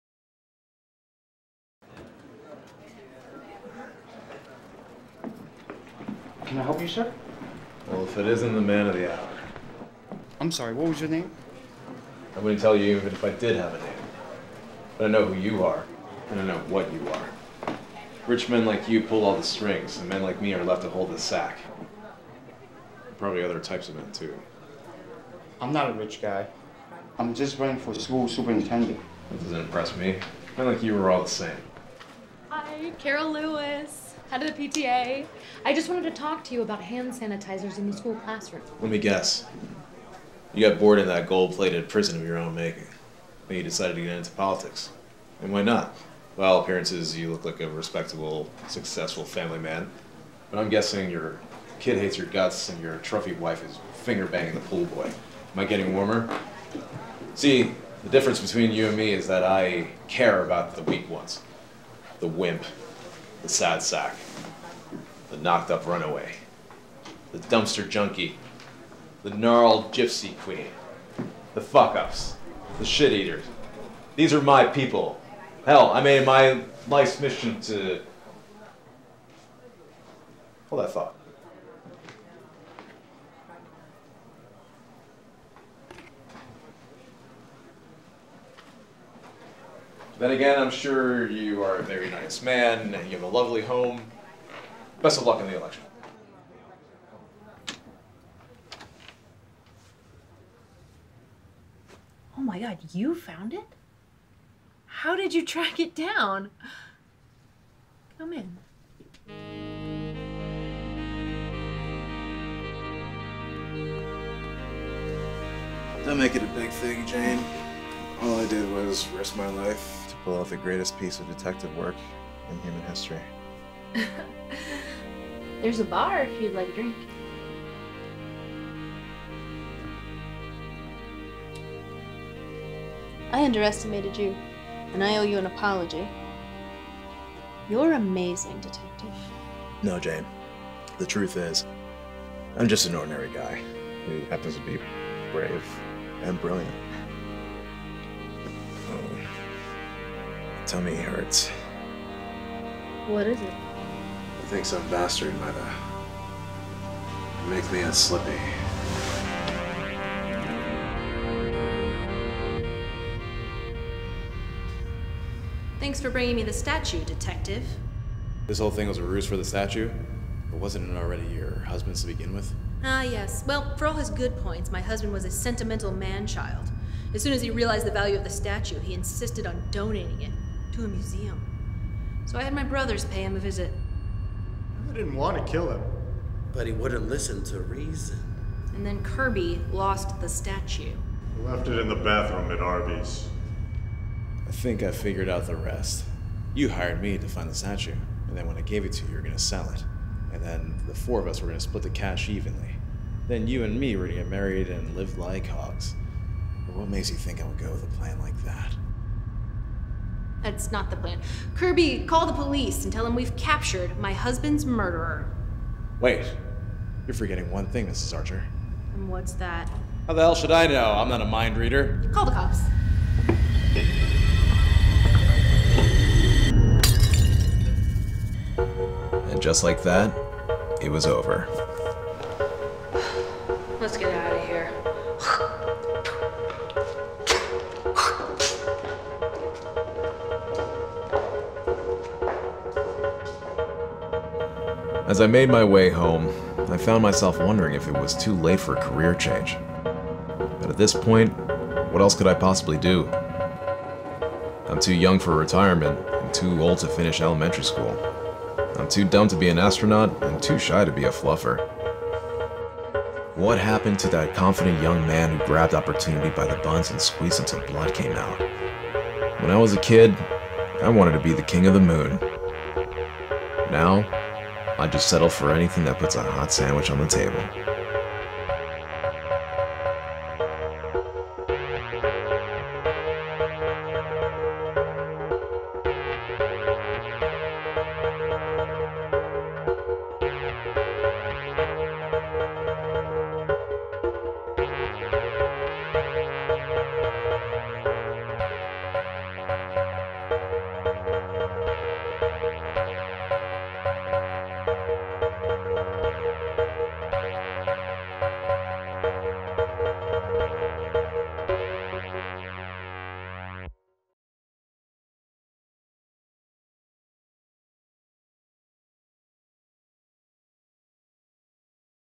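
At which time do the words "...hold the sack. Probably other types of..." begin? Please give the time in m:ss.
0:20.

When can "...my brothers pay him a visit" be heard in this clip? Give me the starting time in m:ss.
3:02.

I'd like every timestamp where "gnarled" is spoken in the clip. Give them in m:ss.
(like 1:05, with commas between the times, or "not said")
1:09.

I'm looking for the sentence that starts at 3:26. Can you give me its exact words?
But what makes you think I would go with a plan like that?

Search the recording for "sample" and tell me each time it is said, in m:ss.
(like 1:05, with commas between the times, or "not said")
not said.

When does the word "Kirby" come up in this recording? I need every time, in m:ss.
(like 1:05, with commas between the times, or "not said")
3:09, 3:31.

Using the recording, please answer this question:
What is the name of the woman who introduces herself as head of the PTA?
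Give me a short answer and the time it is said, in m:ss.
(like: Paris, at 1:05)
Carol Lewis, at 0:32.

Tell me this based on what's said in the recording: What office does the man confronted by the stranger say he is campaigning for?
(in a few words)
School superintendent.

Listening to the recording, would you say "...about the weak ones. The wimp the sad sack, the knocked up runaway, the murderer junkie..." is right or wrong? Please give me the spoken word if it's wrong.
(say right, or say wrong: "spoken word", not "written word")
wrong: "dumpster", not "murderer".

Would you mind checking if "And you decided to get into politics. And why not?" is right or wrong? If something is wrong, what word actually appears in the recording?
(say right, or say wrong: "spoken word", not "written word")
right.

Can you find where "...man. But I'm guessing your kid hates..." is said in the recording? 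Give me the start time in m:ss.
0:49.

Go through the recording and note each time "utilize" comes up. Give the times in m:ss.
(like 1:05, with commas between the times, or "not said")
not said.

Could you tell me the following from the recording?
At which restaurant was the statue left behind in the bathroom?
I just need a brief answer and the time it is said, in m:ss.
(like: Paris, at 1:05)
Arby's, at 3:12.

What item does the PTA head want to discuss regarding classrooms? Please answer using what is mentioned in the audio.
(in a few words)
Hand sanitizers.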